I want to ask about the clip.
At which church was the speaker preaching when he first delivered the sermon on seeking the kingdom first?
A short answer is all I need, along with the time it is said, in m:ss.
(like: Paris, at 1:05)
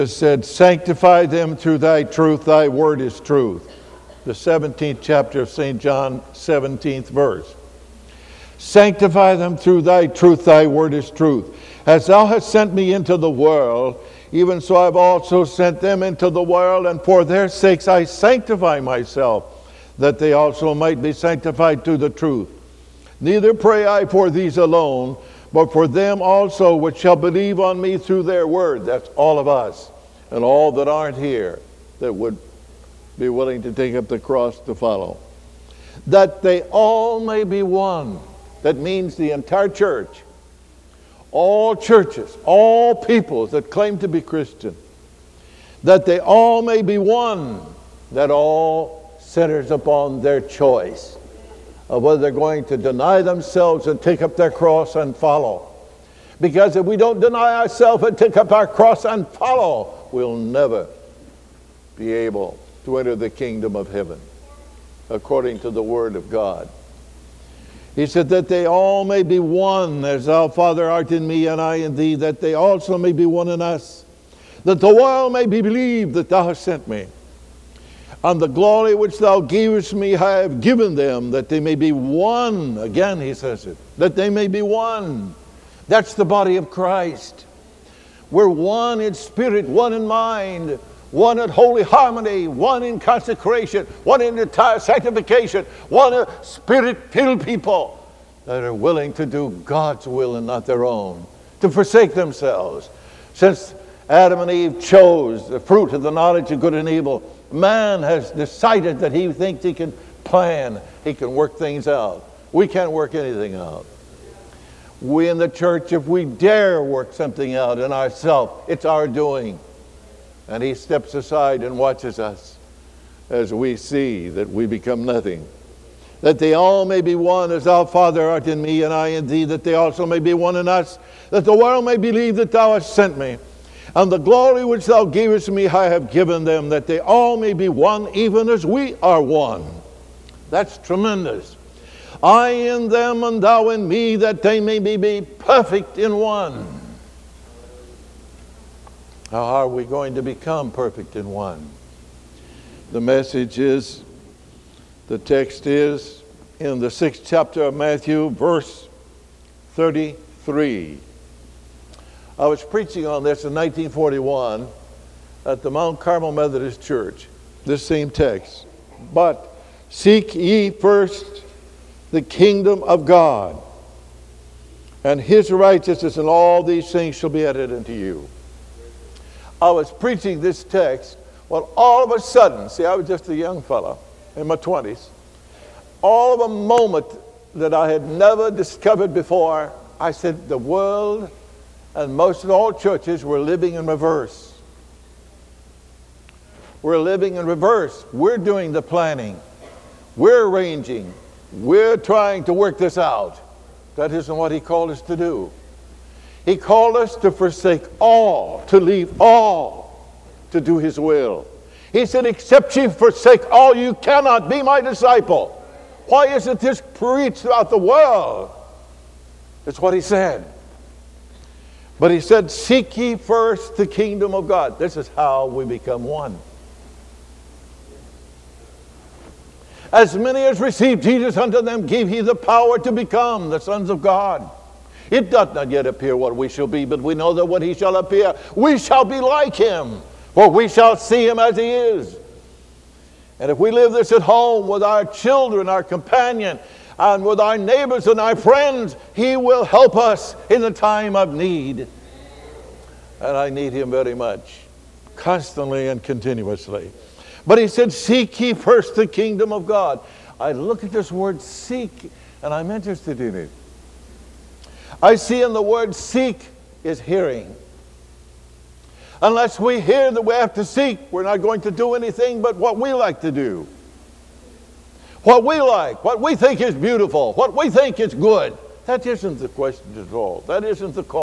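Mount Carmel Methodist Church, at 2:45.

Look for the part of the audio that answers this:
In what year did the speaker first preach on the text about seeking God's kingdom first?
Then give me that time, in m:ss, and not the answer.
2:43.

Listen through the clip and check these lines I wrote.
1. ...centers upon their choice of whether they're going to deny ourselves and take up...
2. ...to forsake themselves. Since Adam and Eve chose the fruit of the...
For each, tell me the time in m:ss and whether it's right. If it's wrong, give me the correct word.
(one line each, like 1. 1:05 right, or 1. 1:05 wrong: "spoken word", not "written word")
1. 0:49 wrong: "themselves", not "ourselves"
2. 1:41 right.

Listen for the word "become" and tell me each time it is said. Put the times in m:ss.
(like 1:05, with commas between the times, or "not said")
2:04, 2:30, 3:45, 3:52.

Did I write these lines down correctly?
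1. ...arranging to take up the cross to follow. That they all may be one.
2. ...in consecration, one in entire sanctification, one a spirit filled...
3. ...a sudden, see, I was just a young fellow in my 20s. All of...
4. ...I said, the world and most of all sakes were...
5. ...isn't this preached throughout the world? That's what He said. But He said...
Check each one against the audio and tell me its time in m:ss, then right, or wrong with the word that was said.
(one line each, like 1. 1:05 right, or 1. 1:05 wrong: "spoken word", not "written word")
1. 0:33 wrong: "willing", not "arranging"
2. 1:32 right
3. 3:02 right
4. 3:09 wrong: "churches", not "sakes"
5. 3:36 right.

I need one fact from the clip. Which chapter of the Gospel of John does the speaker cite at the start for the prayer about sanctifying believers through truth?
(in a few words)
17th chapter.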